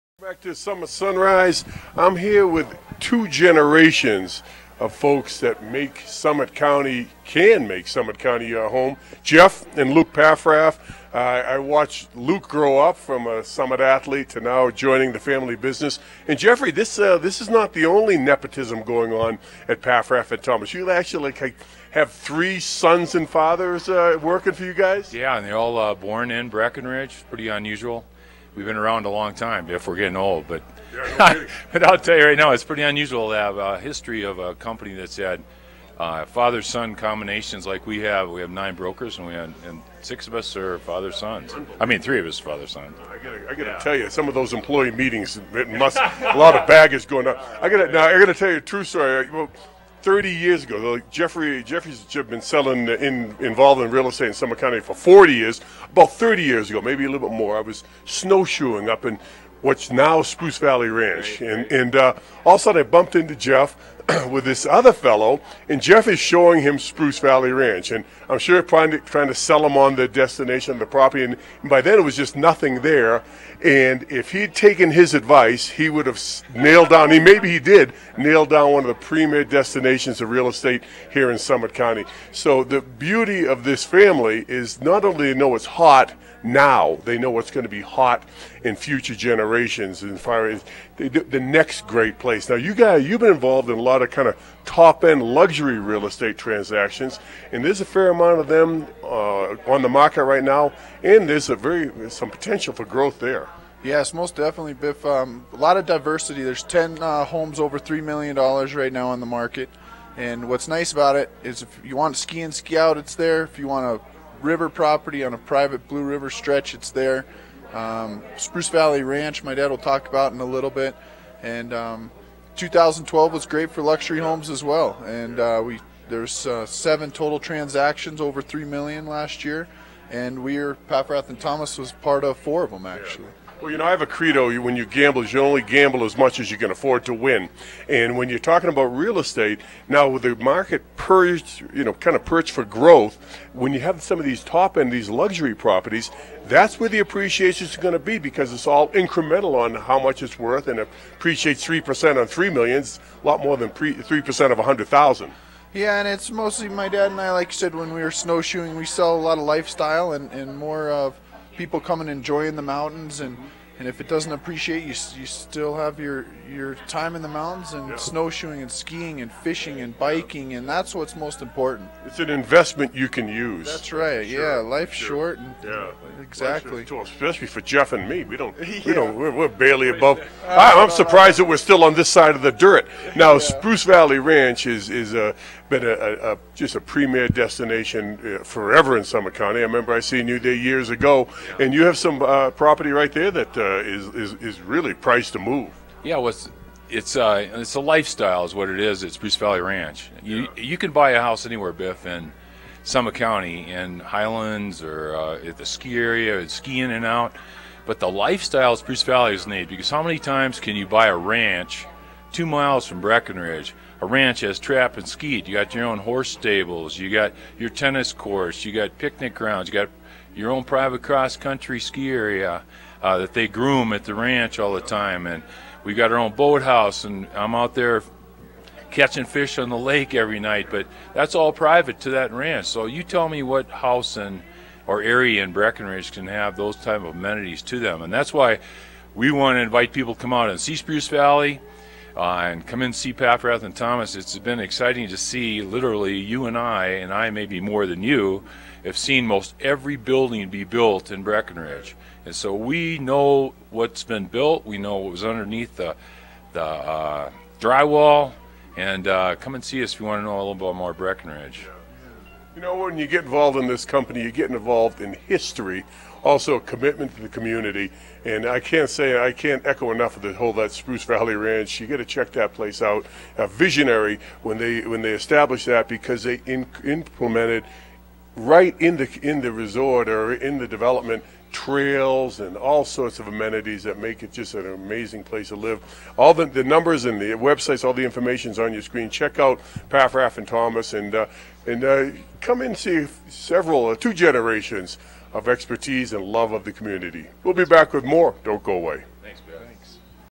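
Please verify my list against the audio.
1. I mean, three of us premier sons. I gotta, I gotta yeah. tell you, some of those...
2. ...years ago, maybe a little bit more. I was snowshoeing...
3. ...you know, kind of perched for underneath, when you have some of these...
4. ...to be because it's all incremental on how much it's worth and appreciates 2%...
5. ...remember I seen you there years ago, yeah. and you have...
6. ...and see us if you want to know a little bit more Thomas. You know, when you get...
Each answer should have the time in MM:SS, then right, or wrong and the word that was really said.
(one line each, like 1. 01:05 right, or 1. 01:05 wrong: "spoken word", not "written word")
1. 00:41 wrong: "father", not "premier"
2. 00:56 right
3. 02:21 wrong: "growth", not "underneath"
4. 02:27 wrong: "3", not "2"
5. 03:09 right
6. 04:19 wrong: "Breckenridge", not "Thomas".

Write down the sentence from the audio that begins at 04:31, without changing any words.
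You got to check that place out.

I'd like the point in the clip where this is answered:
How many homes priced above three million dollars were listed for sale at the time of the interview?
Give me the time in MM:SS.
01:46.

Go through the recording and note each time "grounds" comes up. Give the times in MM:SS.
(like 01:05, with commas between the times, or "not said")
03:39.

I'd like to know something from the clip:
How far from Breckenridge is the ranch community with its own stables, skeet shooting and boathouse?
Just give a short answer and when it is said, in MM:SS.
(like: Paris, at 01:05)
2 miles, at 03:32.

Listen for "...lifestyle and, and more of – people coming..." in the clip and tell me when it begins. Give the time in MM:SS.
02:39.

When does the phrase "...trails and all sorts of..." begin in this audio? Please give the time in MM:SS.
04:41.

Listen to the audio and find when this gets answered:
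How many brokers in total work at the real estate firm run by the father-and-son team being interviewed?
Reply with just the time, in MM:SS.
00:38.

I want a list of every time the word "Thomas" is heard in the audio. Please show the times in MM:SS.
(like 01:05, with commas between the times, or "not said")
00:20, 02:11, 04:03, 04:50.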